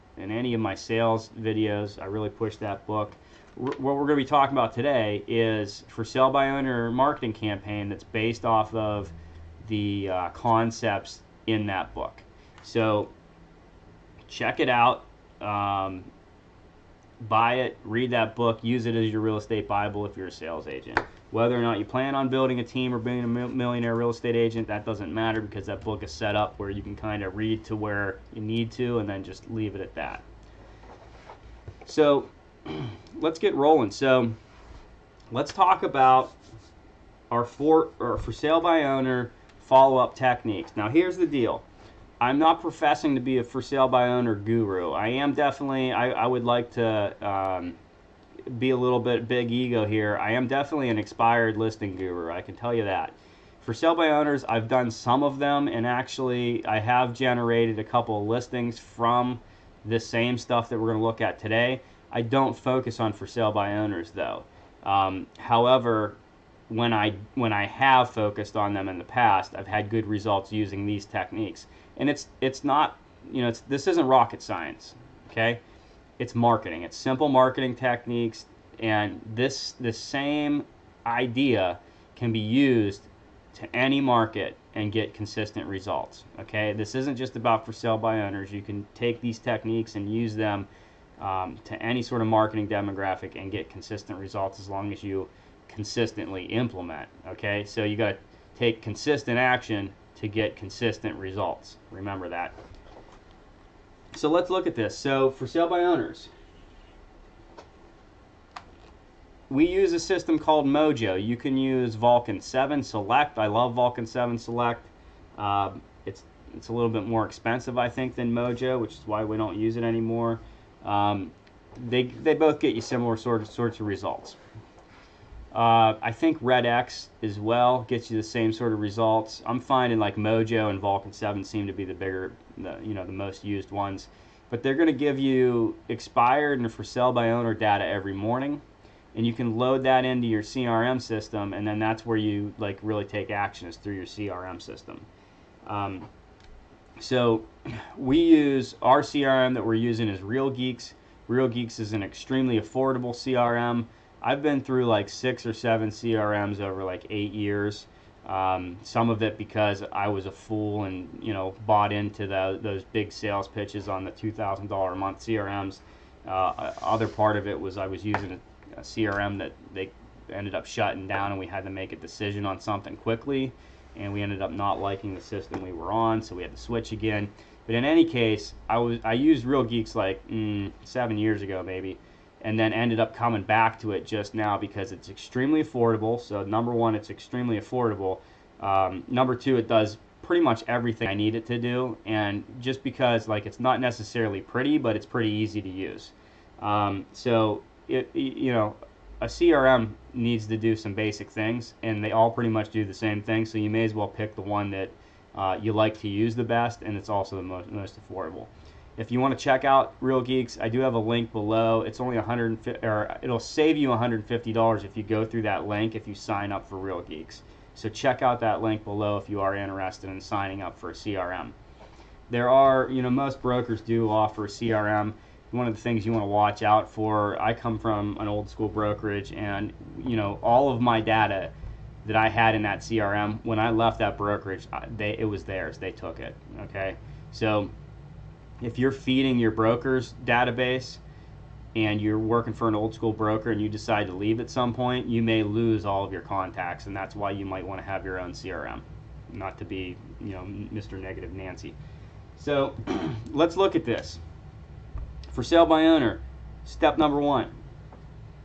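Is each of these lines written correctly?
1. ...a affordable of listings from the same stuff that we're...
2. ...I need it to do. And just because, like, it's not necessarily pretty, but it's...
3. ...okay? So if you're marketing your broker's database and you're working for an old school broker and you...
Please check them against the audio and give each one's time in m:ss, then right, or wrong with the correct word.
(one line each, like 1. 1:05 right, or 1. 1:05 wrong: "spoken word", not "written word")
1. 0:57 wrong: "couple", not "affordable"
2. 3:11 right
3. 3:56 wrong: "feeding", not "marketing".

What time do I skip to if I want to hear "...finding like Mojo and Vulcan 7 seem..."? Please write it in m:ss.
2:09.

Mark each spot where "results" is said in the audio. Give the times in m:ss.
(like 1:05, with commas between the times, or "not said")
1:10, 1:25, 1:34, 1:41, 2:03, 2:08.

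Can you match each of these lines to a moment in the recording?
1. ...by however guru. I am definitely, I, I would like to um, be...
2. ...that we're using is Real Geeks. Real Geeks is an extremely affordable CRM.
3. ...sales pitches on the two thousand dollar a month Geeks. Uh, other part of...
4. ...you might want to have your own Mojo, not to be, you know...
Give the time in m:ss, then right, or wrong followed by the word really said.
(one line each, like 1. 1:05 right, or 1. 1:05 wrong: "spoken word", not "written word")
1. 0:43 wrong: "owner", not "however"
2. 2:29 right
3. 2:43 wrong: "CRMs", not "Geeks"
4. 4:07 wrong: "CRM", not "Mojo".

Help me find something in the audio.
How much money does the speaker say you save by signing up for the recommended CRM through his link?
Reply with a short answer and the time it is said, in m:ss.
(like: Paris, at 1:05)
$150, at 3:33.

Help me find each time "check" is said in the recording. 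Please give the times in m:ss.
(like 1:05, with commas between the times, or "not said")
0:14, 3:29, 3:37.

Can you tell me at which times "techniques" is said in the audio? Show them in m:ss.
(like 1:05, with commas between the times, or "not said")
0:40, 1:11, 1:17, 1:29.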